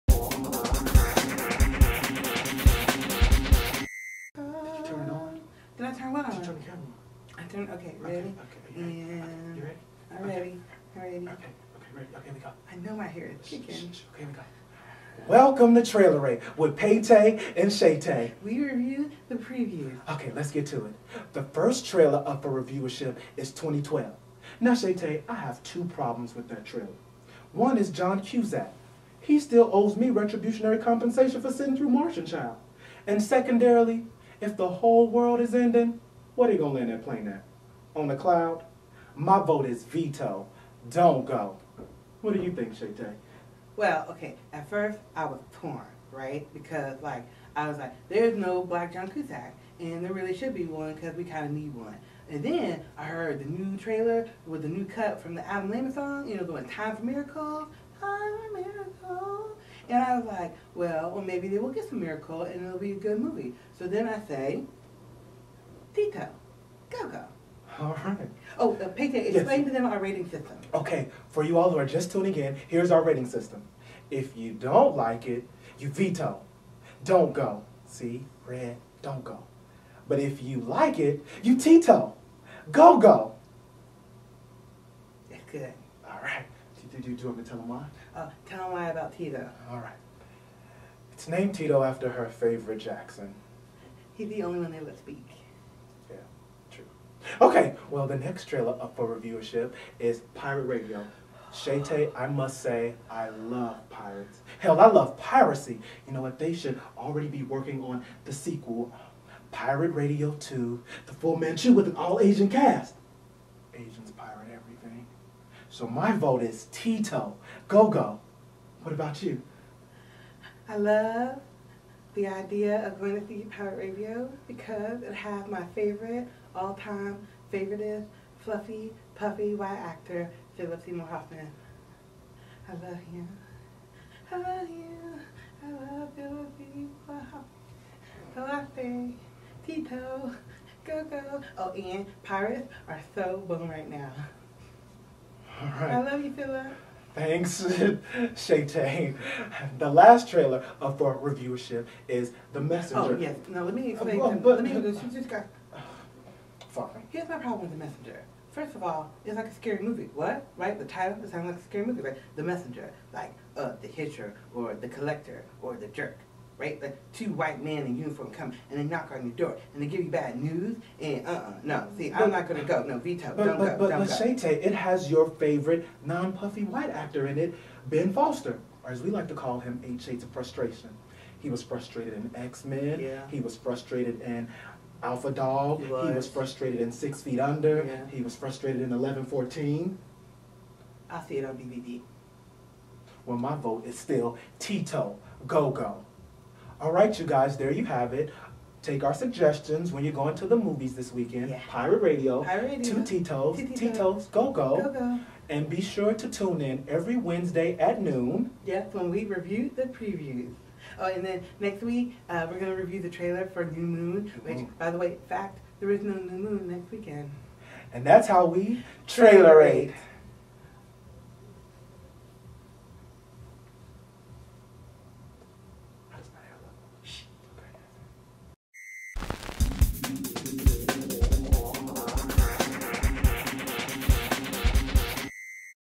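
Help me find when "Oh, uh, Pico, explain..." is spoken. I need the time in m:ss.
1:08.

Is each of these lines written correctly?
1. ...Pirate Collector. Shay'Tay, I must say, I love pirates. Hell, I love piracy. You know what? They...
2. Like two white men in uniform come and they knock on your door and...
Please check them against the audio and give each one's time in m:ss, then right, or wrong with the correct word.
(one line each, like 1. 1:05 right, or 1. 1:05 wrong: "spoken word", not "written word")
1. 1:40 wrong: "Radio", not "Collector"
2. 2:46 right.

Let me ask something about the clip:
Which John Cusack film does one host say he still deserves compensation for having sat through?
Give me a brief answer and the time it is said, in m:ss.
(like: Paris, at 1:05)
Martian Child, at 0:31.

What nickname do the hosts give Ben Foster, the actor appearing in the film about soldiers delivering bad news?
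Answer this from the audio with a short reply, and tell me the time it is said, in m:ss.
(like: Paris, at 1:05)
Eight Shades of Frustration, at 2:59.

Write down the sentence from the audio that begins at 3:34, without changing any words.
by the way, fact, there is no New Moon next weekend.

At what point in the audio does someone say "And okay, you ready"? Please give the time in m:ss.
0:09.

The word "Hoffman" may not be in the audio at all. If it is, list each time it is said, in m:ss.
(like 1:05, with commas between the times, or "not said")
2:11, 2:17.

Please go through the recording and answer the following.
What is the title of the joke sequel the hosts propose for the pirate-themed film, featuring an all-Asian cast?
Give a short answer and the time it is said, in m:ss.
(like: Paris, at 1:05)
The Full Manchu, at 1:51.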